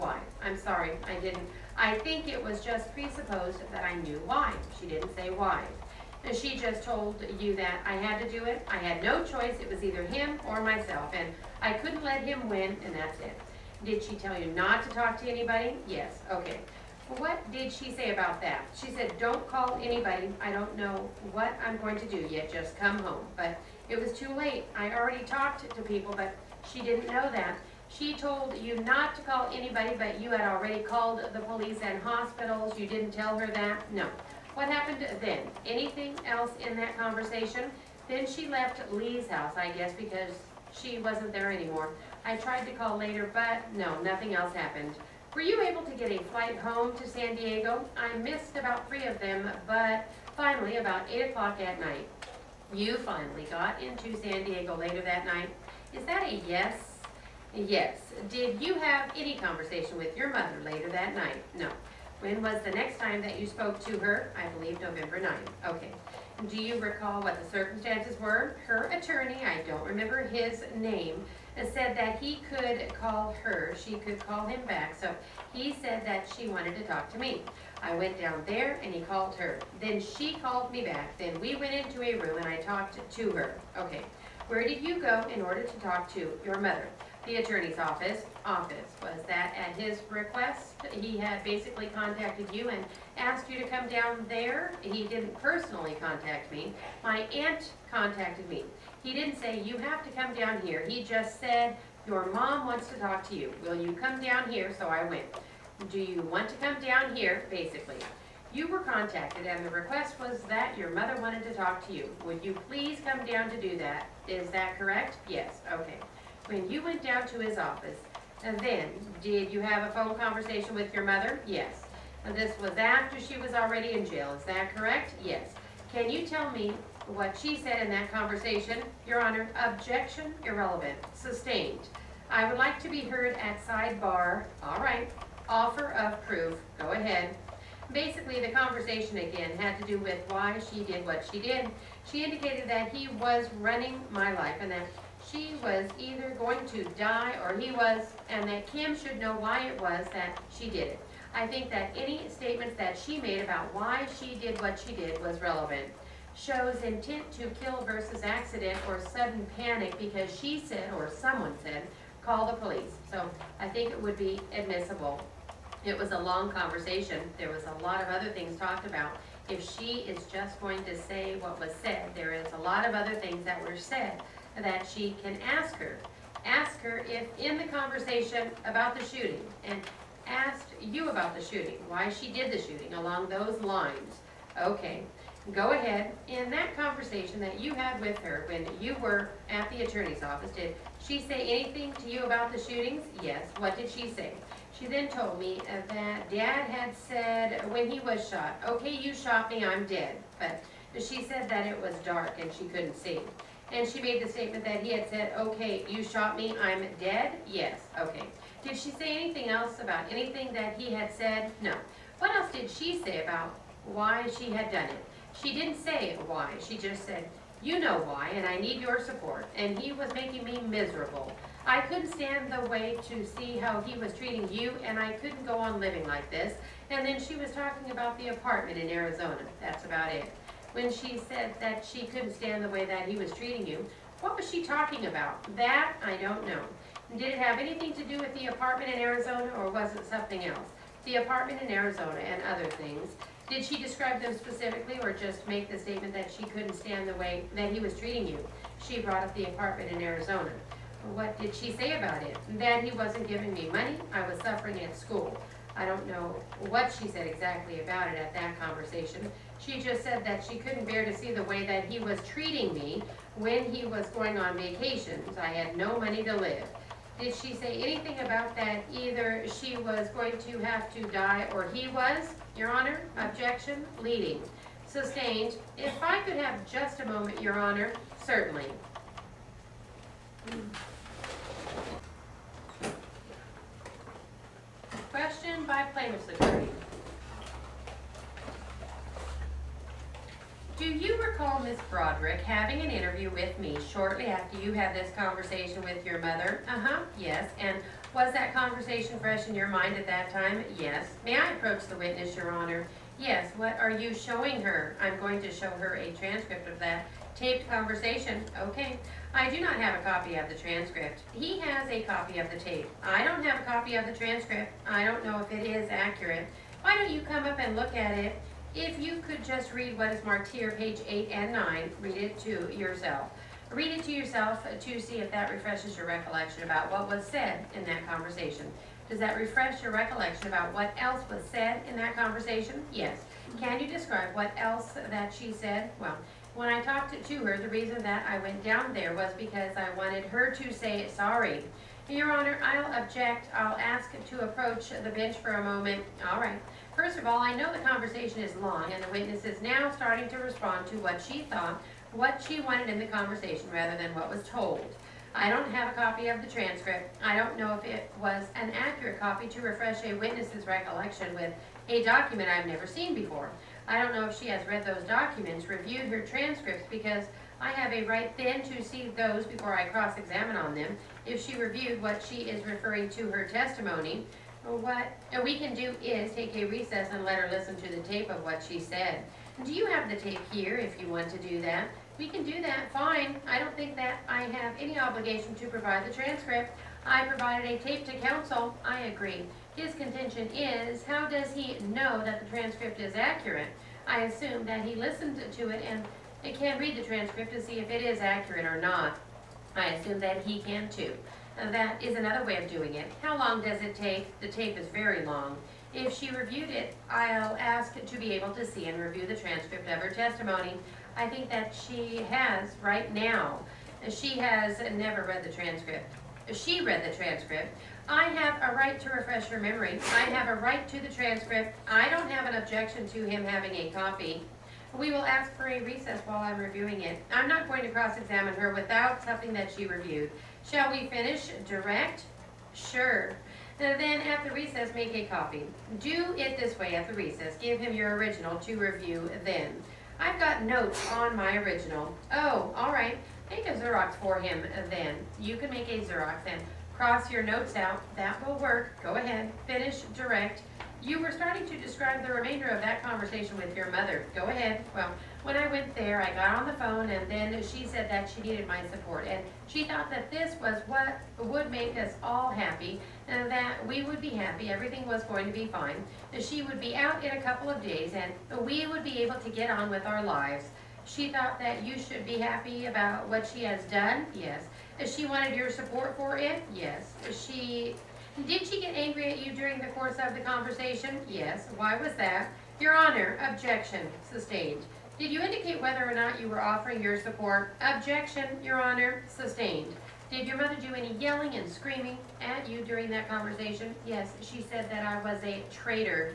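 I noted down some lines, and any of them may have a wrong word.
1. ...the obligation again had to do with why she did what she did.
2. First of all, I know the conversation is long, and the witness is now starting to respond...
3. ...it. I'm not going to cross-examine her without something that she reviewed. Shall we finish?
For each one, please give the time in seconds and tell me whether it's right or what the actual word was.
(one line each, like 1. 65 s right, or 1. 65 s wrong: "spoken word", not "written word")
1. 138 s wrong: "conversation", not "obligation"
2. 346 s right
3. 427 s right.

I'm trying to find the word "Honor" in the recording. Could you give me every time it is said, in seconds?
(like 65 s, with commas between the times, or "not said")
129 s, 272 s, 277 s, 302 s, 342 s, 482 s, 488 s.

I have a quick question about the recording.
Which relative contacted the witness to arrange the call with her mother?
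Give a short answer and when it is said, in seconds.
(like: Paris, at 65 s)
My aunt, at 97 s.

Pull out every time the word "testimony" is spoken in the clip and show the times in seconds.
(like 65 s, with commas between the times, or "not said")
373 s, 410 s.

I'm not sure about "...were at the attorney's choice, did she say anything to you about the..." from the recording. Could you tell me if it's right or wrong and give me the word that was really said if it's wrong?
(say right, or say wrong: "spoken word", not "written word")
wrong: "office", not "choice".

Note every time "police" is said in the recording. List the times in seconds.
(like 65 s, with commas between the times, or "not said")
31 s, 162 s.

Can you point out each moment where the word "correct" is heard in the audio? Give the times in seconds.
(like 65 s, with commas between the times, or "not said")
114 s, 124 s.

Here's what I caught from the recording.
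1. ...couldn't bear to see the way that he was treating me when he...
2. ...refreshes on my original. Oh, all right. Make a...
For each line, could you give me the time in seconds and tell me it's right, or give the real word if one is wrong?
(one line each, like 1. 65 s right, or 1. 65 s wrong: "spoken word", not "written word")
1. 260 s right
2. 440 s wrong: "notes", not "refreshes".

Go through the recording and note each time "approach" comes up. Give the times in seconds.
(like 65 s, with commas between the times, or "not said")
301 s, 344 s.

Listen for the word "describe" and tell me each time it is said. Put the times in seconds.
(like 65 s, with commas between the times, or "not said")
243 s, 333 s, 451 s.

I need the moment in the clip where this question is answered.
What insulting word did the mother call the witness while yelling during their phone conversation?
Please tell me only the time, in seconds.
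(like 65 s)
495 s.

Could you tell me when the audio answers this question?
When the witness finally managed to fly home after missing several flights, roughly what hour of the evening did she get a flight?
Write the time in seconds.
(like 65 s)
51 s.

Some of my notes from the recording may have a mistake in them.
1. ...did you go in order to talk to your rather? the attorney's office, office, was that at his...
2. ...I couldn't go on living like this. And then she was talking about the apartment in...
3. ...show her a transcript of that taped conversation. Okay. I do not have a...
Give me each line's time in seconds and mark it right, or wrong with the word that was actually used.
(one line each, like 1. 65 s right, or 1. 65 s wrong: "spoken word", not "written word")
1. 84 s wrong: "mother", not "rather"
2. 224 s right
3. 305 s right.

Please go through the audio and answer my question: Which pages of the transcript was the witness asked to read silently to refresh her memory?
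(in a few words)
page 8 and 9.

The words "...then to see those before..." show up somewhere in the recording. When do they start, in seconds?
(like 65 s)
368 s.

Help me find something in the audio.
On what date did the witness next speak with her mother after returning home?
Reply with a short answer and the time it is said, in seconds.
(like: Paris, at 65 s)
November 9, at 64 s.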